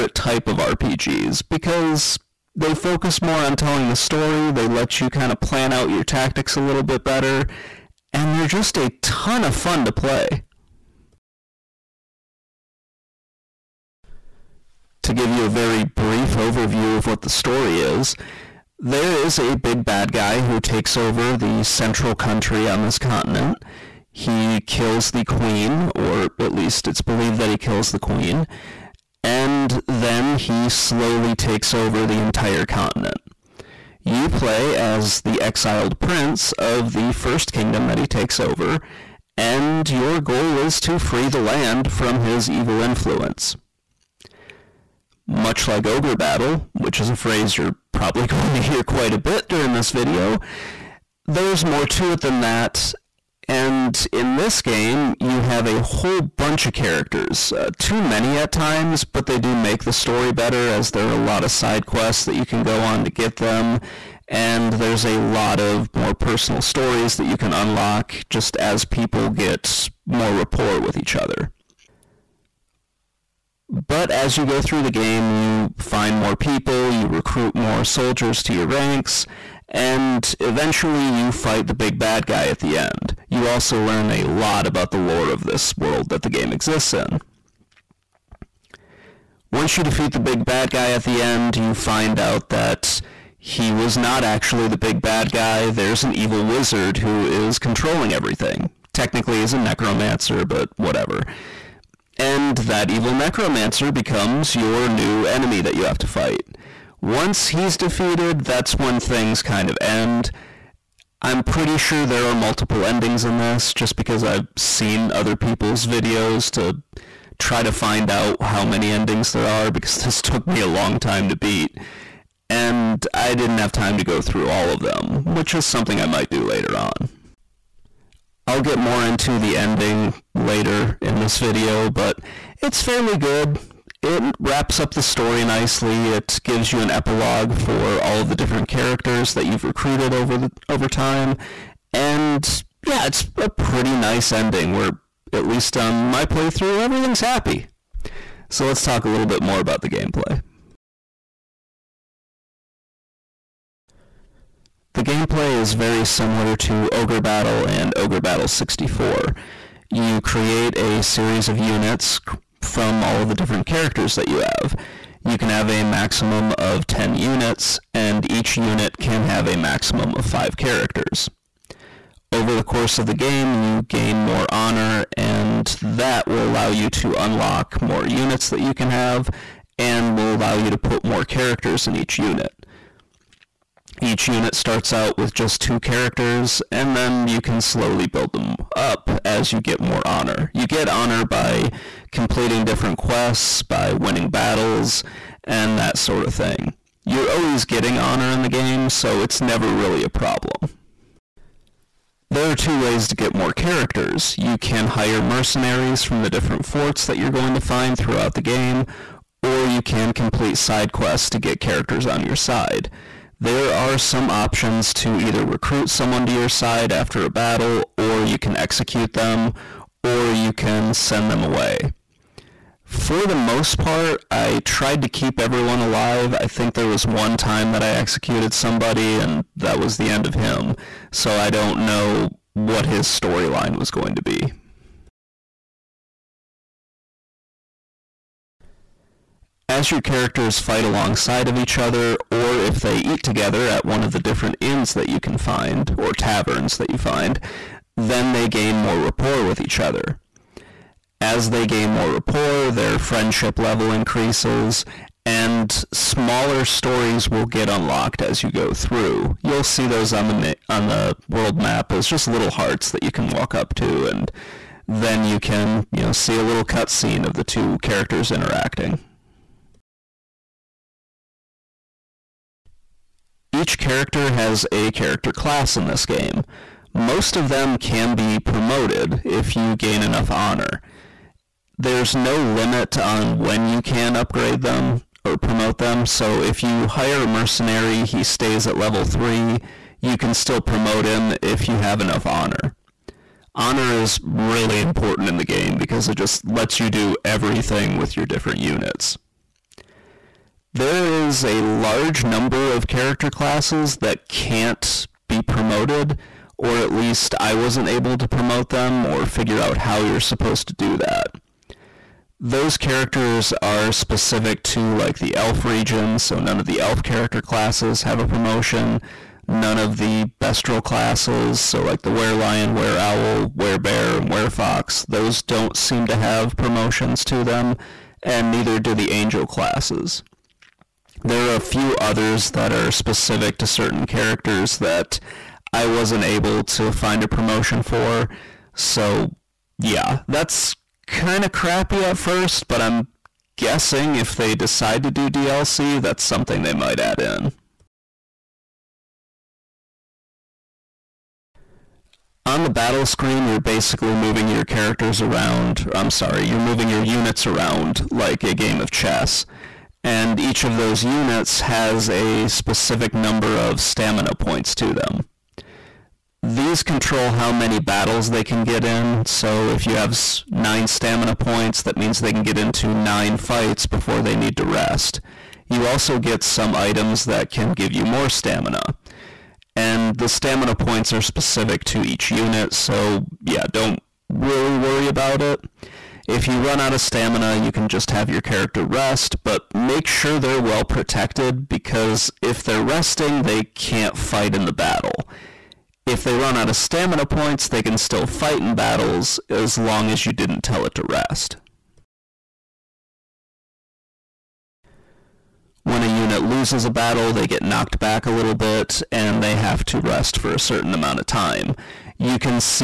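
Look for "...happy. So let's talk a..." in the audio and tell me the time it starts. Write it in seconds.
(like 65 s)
147 s.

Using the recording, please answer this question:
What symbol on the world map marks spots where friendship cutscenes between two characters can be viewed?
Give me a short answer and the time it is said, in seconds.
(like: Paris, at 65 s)
hearts, at 262 s.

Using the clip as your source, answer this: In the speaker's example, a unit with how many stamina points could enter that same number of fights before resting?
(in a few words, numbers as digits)
9.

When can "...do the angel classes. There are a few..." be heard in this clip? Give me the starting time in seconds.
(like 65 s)
328 s.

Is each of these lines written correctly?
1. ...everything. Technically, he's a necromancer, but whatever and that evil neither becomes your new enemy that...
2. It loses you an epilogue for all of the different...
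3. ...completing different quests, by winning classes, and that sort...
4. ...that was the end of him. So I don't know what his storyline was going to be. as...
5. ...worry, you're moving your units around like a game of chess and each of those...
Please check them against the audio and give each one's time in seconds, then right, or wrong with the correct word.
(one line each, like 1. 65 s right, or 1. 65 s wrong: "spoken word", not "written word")
1. 98 s wrong: "necromancer", not "neither"
2. 136 s wrong: "gives", not "loses"
3. 192 s wrong: "battles", not "classes"
4. 229 s right
5. 356 s wrong: "sorry", not "worry".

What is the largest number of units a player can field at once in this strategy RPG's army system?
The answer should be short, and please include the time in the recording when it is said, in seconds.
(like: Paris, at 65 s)
10, at 166 s.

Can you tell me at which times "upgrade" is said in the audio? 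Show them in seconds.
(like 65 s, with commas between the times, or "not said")
284 s.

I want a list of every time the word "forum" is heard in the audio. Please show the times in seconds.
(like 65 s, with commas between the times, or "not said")
not said.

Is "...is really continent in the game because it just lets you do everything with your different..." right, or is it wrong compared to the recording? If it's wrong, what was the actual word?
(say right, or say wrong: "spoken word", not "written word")
wrong: "important", not "continent".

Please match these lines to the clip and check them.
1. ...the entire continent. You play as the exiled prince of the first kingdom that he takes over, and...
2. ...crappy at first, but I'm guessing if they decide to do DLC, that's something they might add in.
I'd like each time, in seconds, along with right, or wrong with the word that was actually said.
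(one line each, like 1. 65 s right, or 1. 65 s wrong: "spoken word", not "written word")
1. 32 s right
2. 341 s right.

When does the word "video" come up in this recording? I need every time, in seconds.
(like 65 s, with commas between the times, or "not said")
49 s, 115 s, 131 s.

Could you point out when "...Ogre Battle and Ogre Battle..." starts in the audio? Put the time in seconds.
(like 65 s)
156 s.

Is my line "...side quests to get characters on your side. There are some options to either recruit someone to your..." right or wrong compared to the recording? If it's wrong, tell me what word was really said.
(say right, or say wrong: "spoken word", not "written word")
right.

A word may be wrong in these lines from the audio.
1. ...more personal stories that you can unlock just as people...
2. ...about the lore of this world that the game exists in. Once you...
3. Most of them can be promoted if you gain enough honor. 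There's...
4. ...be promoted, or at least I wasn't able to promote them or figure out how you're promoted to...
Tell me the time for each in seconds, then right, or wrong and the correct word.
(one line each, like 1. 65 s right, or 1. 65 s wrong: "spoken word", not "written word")
1. 65 s right
2. 84 s right
3. 276 s right
4. 305 s wrong: "supposed", not "promoted".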